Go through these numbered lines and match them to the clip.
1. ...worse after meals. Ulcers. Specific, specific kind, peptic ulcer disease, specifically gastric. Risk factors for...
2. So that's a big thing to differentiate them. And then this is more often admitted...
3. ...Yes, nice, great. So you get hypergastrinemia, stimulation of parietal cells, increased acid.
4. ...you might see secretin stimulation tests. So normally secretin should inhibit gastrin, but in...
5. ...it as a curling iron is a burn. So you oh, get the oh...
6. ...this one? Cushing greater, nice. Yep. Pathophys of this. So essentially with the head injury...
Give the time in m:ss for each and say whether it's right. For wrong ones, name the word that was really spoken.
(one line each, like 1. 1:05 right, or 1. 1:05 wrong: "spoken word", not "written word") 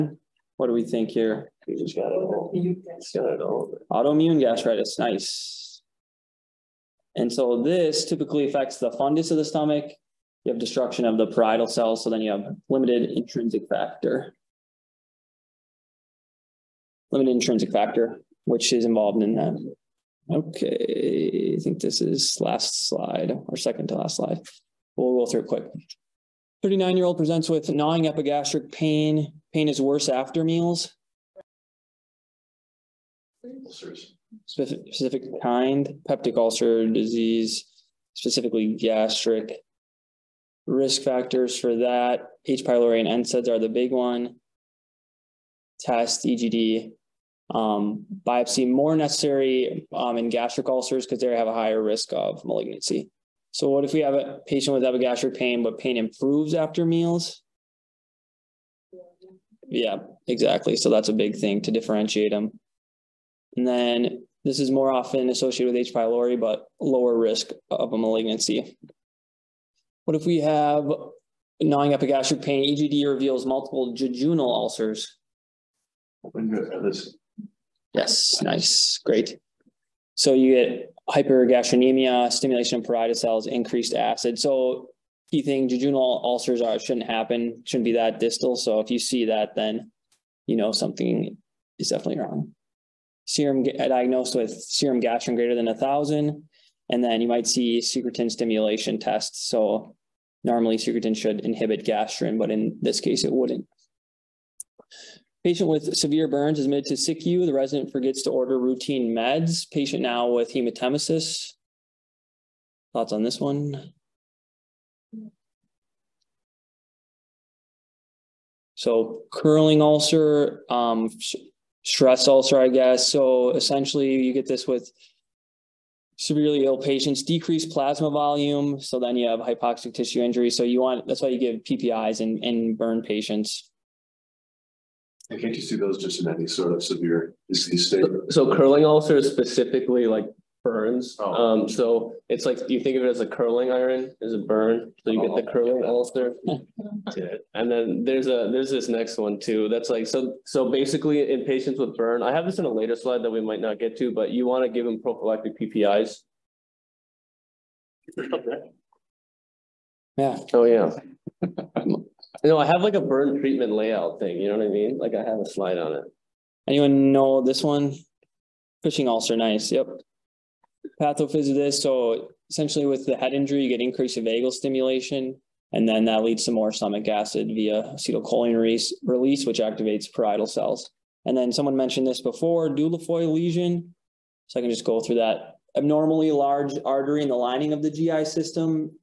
1. 0:29 right
2. 1:00 wrong: "associated", not "admitted"
3. 1:17 right
4. 1:37 right
5. 2:23 right
6. 2:47 wrong: "ulcer", not "greater".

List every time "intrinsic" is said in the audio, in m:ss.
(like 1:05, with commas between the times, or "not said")
0:13, 0:17.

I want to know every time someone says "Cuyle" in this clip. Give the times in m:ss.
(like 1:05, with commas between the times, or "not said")
not said.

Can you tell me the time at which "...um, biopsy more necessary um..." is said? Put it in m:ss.
0:47.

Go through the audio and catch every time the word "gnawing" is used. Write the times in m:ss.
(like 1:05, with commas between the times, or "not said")
0:27, 1:11.